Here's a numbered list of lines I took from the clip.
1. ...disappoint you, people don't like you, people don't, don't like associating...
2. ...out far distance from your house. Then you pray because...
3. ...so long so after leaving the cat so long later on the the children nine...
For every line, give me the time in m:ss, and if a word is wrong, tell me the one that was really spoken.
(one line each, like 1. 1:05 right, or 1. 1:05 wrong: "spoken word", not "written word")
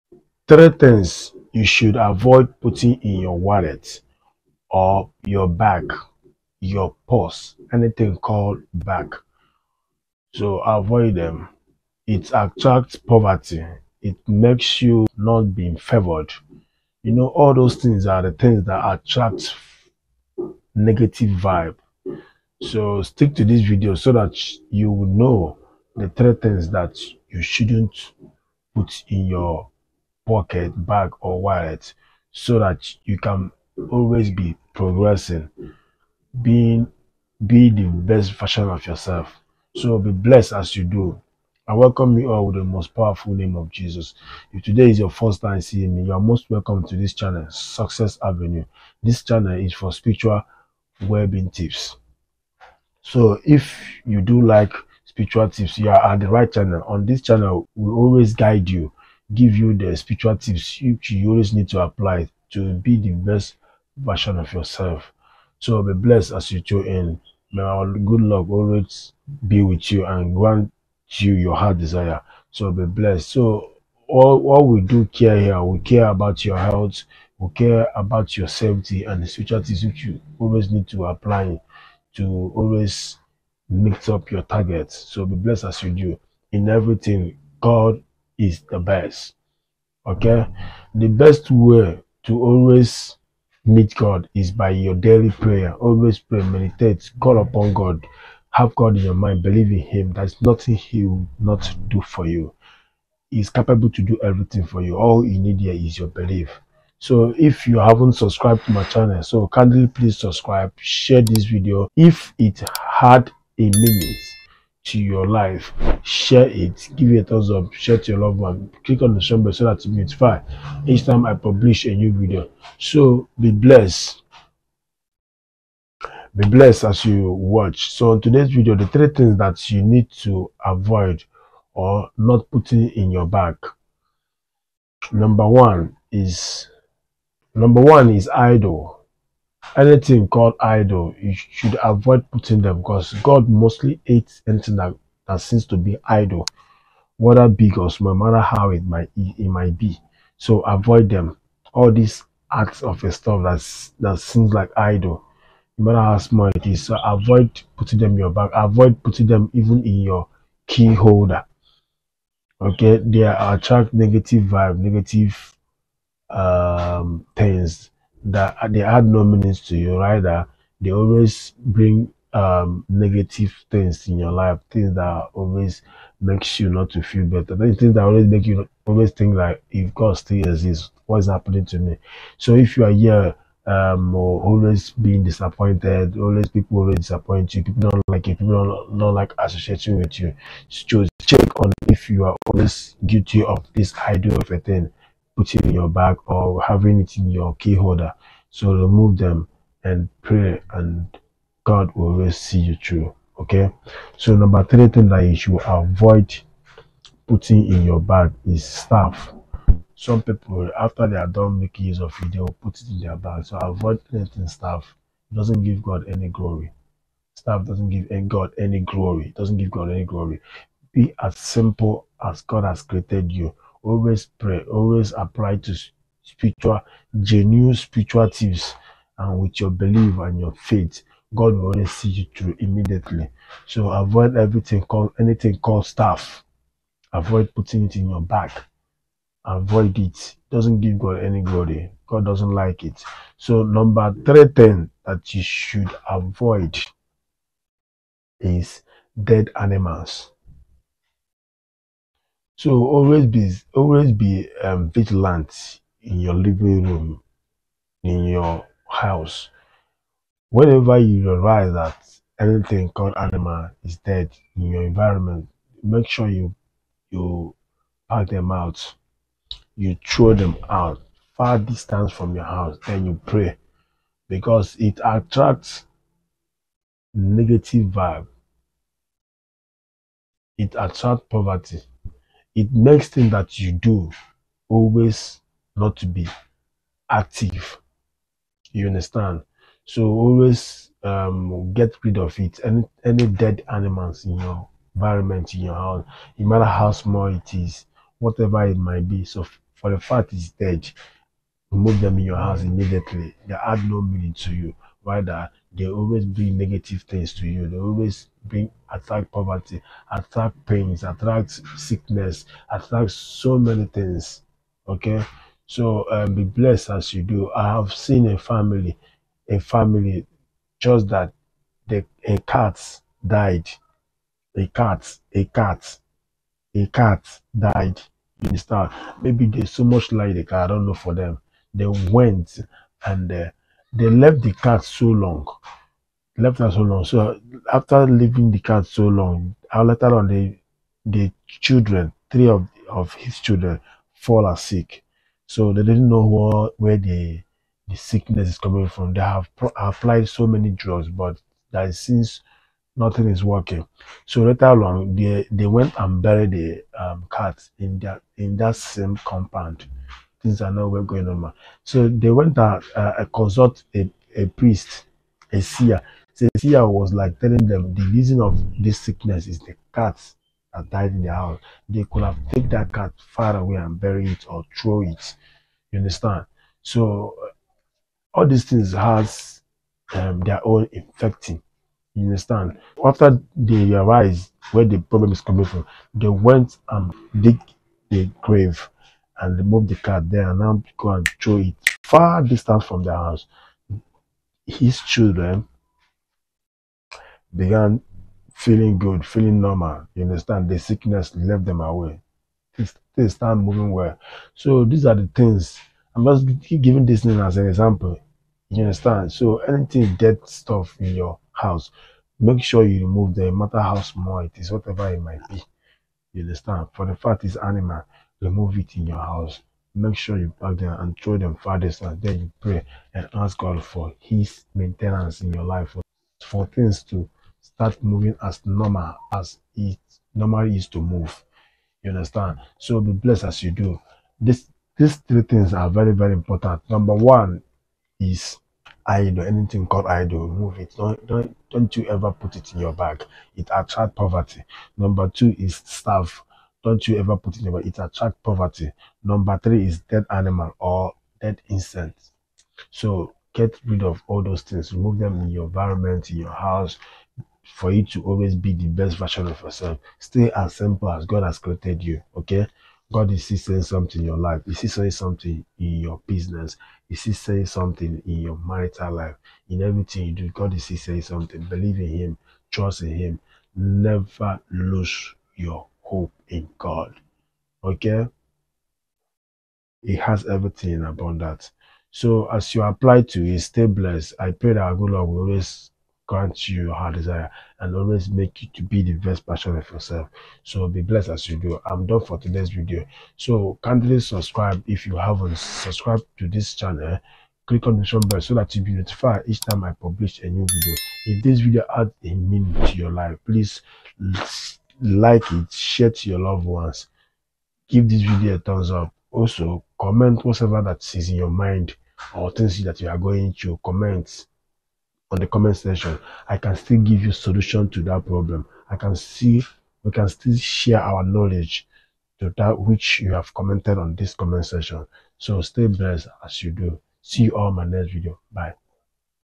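1. 3:06 right
2. 4:30 right
3. 5:36 wrong: "three", not "nine".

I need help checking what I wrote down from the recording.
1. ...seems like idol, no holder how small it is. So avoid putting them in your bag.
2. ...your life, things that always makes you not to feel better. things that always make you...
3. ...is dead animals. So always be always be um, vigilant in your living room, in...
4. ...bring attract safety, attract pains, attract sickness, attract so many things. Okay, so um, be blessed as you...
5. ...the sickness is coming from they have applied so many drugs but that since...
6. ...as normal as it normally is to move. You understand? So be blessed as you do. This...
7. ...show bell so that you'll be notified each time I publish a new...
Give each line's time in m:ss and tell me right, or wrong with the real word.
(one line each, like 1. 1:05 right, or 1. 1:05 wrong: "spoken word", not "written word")
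1. 2:34 wrong: "matter", not "holder"
2. 2:54 right
3. 4:08 right
4. 5:08 wrong: "poverty", not "safety"
5. 5:47 right
6. 7:08 right
7. 8:18 right.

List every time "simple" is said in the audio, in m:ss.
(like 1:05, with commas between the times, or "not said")
3:41, 7:40.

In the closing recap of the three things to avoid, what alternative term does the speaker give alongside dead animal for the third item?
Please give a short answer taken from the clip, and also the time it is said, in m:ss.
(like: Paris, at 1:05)
Dead incense, at 7:31.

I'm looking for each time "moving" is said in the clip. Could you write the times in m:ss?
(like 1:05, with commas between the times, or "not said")
6:43, 7:08.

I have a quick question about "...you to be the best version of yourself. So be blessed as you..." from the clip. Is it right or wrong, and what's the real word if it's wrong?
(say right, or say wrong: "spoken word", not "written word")
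right.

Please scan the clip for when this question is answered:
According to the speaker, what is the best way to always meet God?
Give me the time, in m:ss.
1:34.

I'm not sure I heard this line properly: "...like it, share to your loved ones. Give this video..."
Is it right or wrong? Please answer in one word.
right.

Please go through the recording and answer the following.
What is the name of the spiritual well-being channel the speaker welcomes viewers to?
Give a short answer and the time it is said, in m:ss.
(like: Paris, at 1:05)
Success Avenue, at 0:47.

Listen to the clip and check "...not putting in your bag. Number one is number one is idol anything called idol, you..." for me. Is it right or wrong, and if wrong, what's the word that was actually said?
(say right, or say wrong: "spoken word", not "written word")
right.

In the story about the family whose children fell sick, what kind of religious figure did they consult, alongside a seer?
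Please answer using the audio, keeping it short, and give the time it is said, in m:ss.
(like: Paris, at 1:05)
A priest, at 6:04.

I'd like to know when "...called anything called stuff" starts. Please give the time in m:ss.
3:54.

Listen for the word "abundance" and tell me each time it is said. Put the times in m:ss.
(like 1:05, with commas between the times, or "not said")
8:01.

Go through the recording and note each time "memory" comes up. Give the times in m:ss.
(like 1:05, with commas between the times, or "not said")
not said.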